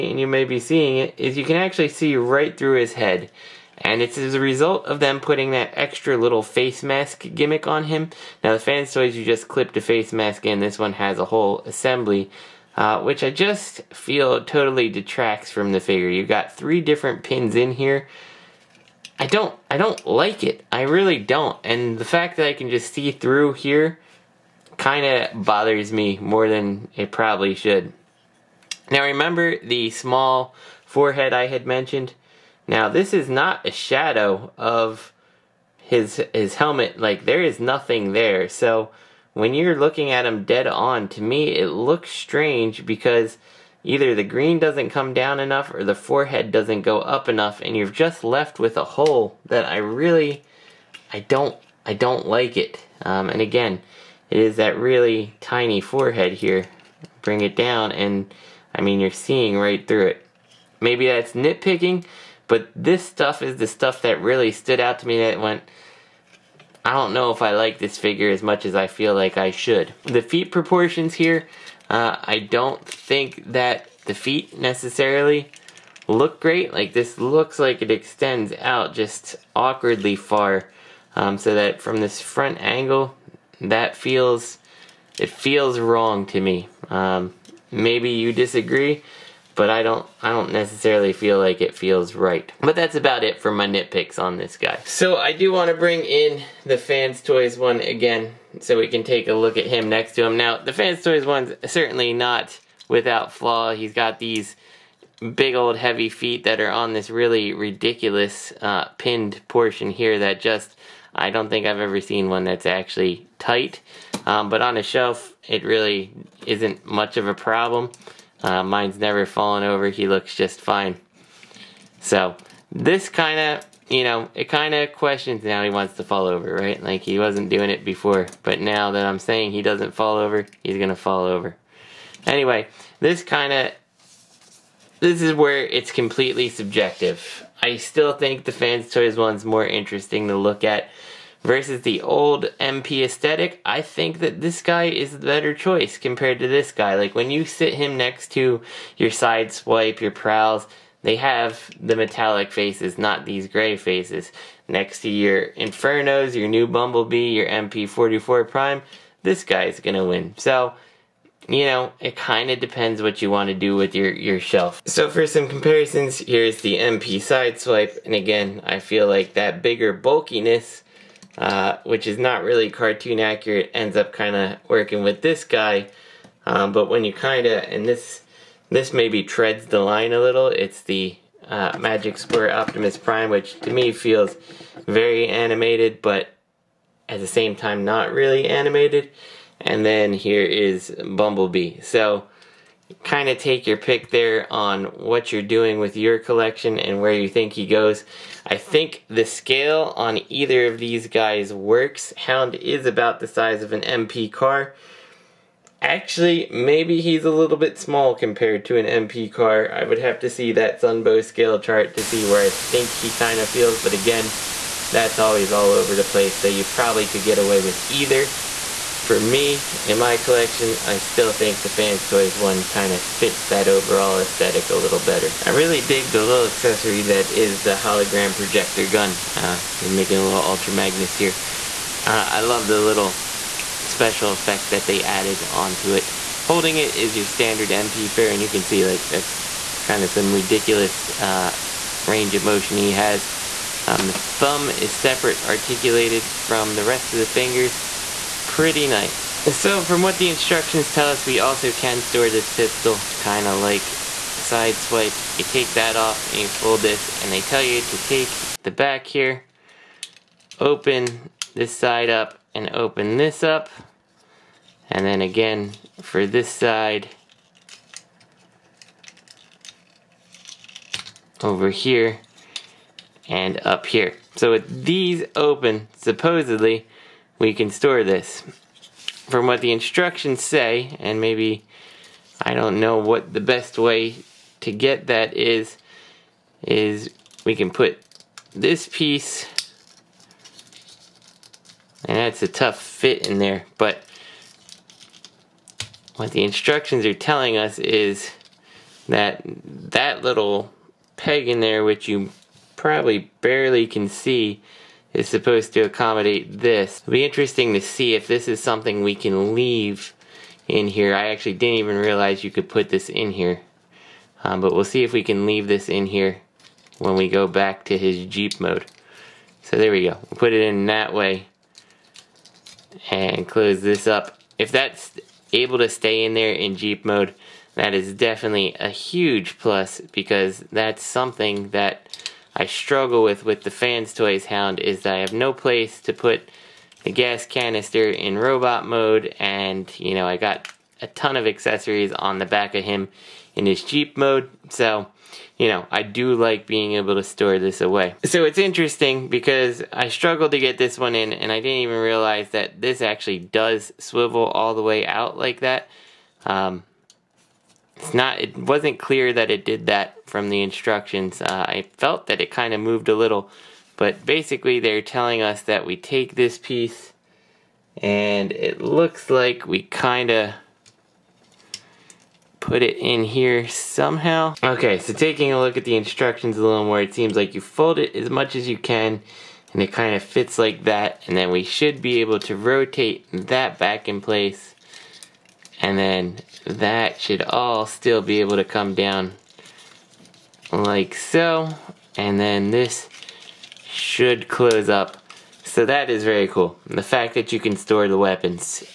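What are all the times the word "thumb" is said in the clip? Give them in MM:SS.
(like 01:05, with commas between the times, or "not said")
04:04.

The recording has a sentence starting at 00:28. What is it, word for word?
Now remember the small forehead I had mentioned?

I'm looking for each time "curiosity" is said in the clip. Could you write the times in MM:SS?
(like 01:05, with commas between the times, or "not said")
not said.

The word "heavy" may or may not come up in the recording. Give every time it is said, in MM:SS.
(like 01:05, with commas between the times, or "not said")
01:45.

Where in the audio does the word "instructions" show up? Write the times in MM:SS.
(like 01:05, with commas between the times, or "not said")
04:10, 04:39, 04:56, 06:00, 06:15.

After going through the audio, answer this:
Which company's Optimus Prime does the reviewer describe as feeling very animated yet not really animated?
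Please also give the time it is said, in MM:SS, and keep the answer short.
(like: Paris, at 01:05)
Magic Square, at 03:01.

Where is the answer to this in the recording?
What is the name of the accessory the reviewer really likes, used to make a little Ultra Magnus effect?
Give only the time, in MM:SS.
03:47.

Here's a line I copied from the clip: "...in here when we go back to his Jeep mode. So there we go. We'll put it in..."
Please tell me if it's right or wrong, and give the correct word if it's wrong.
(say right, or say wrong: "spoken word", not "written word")
right.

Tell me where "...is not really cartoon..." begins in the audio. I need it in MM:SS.
02:52.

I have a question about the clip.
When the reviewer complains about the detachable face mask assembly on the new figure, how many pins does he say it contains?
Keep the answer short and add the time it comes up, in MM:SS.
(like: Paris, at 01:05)
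3, at 00:16.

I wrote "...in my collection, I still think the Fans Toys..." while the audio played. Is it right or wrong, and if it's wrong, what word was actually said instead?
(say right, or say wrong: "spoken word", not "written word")
right.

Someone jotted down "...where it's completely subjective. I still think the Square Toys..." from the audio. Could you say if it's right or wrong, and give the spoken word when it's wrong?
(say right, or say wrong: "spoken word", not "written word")
wrong: "Fans", not "Square".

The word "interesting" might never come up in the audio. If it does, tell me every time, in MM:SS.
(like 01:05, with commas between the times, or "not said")
02:19, 05:07, 05:48.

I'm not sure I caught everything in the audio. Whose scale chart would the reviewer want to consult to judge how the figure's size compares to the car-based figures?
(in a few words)
Sunbow.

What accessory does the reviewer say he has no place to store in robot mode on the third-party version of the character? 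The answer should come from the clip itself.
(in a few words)
gas canister.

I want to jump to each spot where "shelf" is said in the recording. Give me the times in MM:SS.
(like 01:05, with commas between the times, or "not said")
01:54, 02:44.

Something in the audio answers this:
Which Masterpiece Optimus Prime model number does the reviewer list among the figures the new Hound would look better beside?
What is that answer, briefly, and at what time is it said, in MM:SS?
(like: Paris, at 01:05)
MP44, at 02:37.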